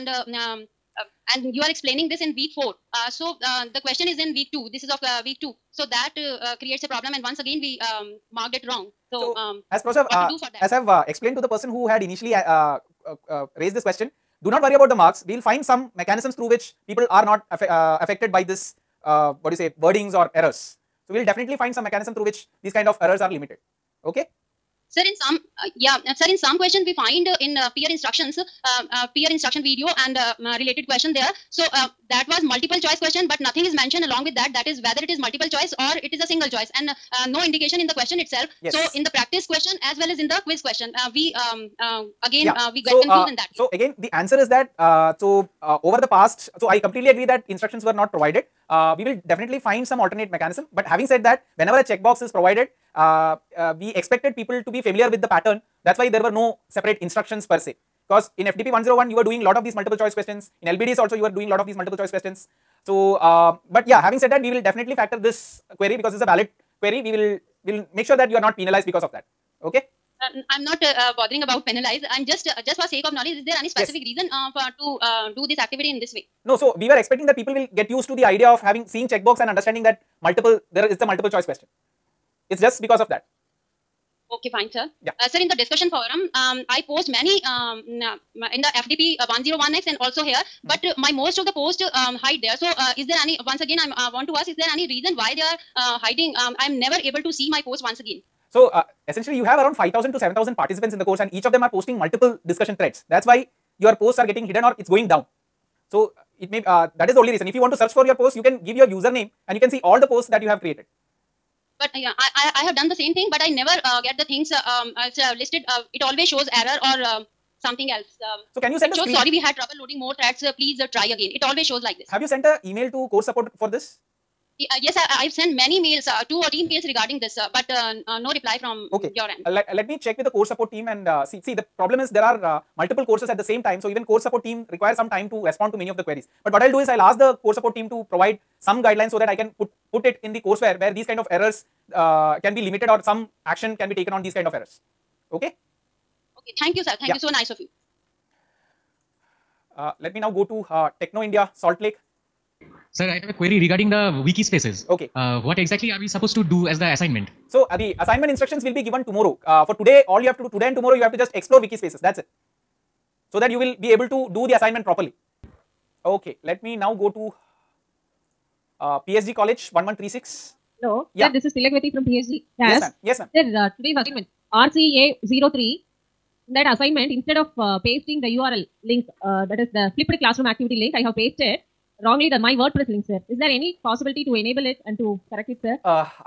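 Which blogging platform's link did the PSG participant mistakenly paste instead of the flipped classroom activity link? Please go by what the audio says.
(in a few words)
WordPress.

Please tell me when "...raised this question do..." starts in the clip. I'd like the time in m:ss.
0:13.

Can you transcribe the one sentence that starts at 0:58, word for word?
Because in FDP 101, you were doing lot of these multiple choice questions.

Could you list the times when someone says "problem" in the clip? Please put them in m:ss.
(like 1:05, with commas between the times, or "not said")
0:06, 2:11.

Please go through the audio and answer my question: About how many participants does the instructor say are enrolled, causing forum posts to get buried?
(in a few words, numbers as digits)
5000 to 7000.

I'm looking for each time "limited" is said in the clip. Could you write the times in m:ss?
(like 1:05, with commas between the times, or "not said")
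0:23, 2:22.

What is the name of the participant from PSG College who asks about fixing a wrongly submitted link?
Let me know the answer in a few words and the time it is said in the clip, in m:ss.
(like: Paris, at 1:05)
Tilakvati, at 2:51.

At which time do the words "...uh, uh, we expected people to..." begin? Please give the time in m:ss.
0:52.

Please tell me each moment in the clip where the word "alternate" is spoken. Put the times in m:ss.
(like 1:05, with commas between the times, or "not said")
0:49.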